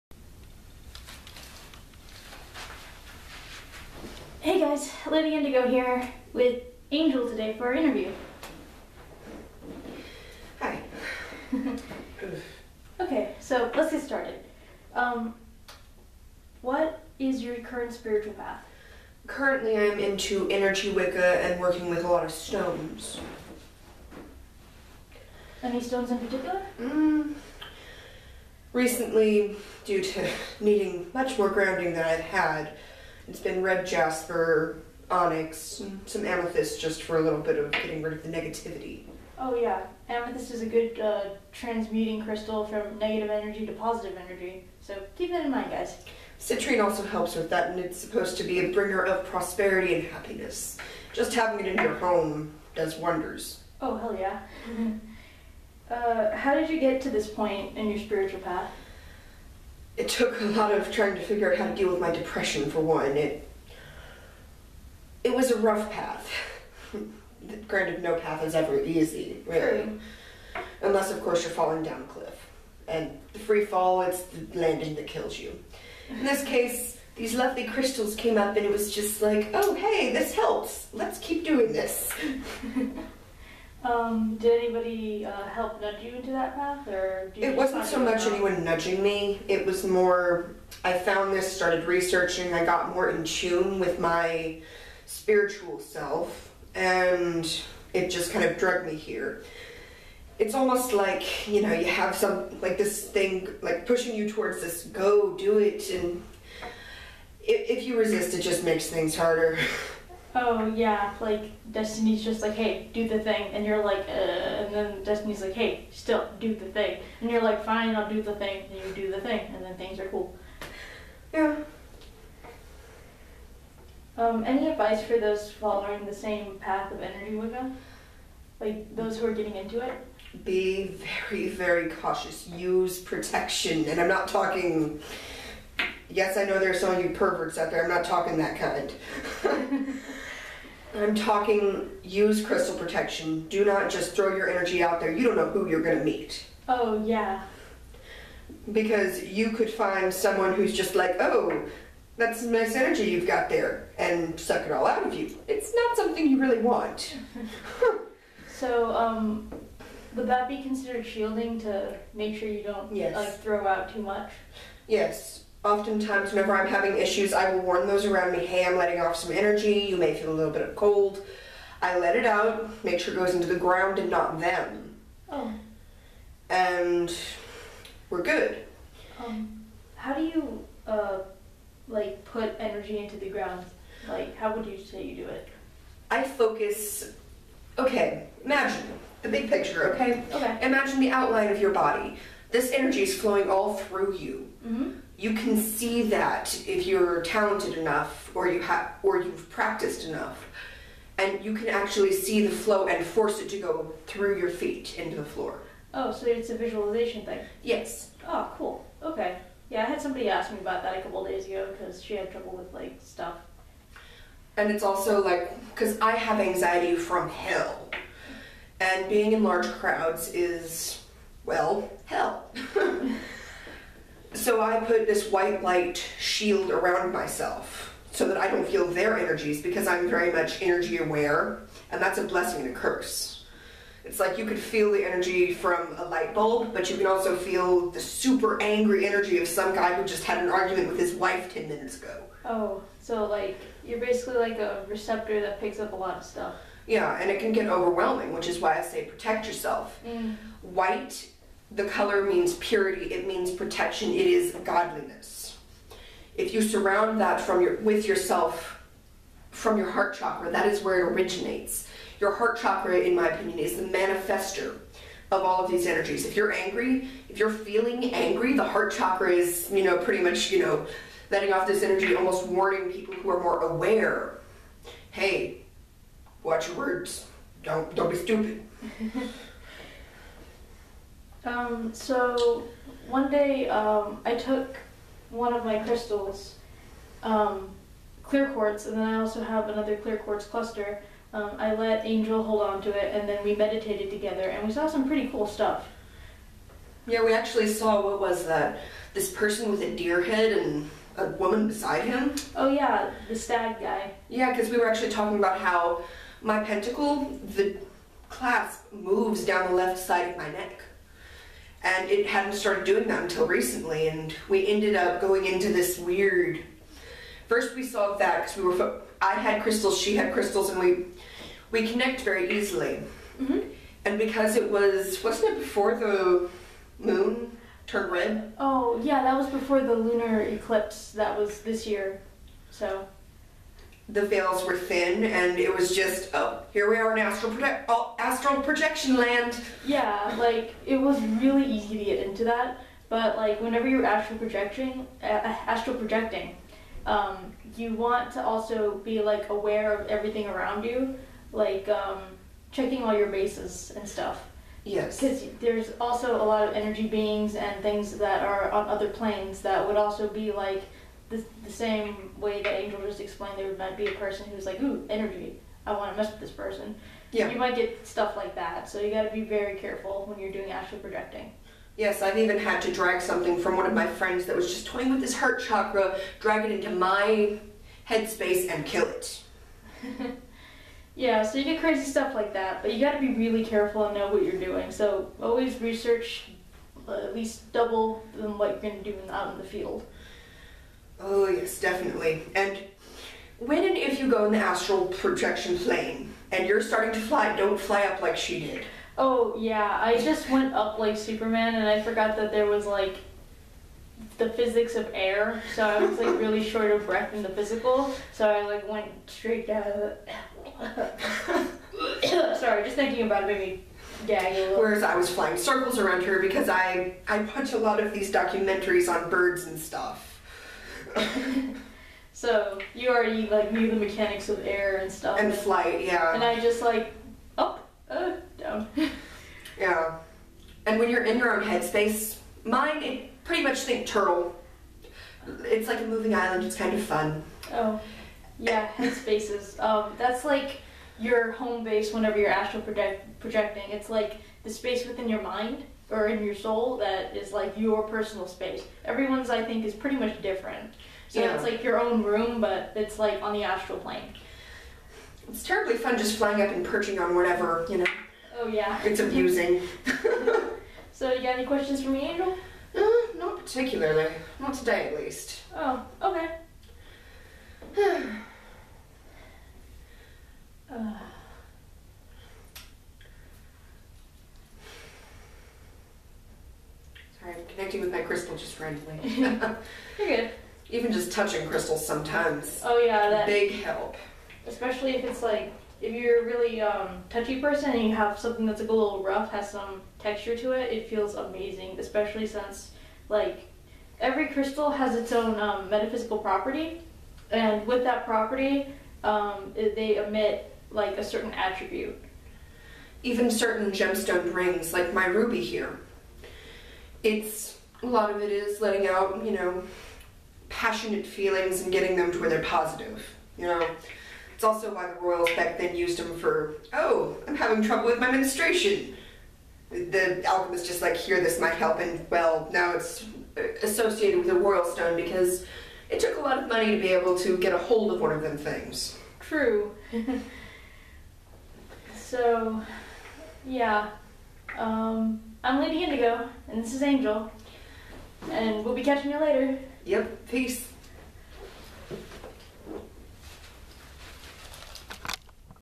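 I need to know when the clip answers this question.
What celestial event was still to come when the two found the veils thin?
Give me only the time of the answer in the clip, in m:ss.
5:29.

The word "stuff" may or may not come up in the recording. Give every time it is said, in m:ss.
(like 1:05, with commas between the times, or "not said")
3:33, 4:06, 4:55, 5:54, 6:08, 6:22, 6:59, 7:05.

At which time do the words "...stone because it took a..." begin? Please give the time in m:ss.
8:44.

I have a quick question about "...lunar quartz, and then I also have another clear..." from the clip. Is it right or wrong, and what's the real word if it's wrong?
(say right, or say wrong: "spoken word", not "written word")
wrong: "clear", not "lunar".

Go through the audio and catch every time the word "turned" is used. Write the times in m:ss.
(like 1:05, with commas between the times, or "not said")
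5:27.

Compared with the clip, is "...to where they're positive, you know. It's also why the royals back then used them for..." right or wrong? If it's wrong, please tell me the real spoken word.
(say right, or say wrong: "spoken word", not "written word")
right.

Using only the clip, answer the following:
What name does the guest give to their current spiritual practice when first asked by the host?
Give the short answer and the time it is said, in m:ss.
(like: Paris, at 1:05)
Energy Wicca, at 0:20.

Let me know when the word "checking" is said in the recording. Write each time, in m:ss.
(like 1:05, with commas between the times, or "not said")
5:52.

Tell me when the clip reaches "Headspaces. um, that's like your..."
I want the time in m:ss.
7:18.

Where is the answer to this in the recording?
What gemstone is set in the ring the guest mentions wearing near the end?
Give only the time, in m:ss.
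8:25.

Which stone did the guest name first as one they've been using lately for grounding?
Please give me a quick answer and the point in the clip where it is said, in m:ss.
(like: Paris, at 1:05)
Red jasper, at 0:33.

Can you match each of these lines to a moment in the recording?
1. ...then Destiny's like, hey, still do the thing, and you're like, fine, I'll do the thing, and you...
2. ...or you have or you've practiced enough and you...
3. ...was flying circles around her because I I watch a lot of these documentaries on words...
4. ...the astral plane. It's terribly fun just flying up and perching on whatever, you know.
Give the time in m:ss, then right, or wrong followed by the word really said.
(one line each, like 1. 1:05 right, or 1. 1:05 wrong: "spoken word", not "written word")
1. 1:54 right
2. 3:18 right
3. 6:55 wrong: "birds", not "words"
4. 7:33 right.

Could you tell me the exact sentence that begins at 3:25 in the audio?
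Oh, so it's a visualization thing.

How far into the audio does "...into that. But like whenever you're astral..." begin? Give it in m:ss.
5:42.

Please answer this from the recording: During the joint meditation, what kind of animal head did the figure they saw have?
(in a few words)
Deer.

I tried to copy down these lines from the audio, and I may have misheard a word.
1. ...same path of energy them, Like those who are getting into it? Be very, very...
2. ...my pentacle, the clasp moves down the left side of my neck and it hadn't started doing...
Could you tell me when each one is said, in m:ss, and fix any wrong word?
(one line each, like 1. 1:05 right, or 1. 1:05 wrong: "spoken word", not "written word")
1. 2:06 right
2. 5:06 right.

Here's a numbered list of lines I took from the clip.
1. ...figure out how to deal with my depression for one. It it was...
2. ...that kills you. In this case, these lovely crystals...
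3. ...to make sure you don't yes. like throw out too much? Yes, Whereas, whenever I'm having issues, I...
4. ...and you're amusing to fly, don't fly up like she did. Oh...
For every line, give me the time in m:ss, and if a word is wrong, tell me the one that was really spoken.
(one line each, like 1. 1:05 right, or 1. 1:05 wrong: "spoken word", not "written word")
1. 1:01 right
2. 1:14 right
3. 2:41 wrong: "Oftentimes", not "Whereas"
4. 6:36 wrong: "starting", not "amusing".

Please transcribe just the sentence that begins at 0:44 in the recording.
So keep that in mind, guys.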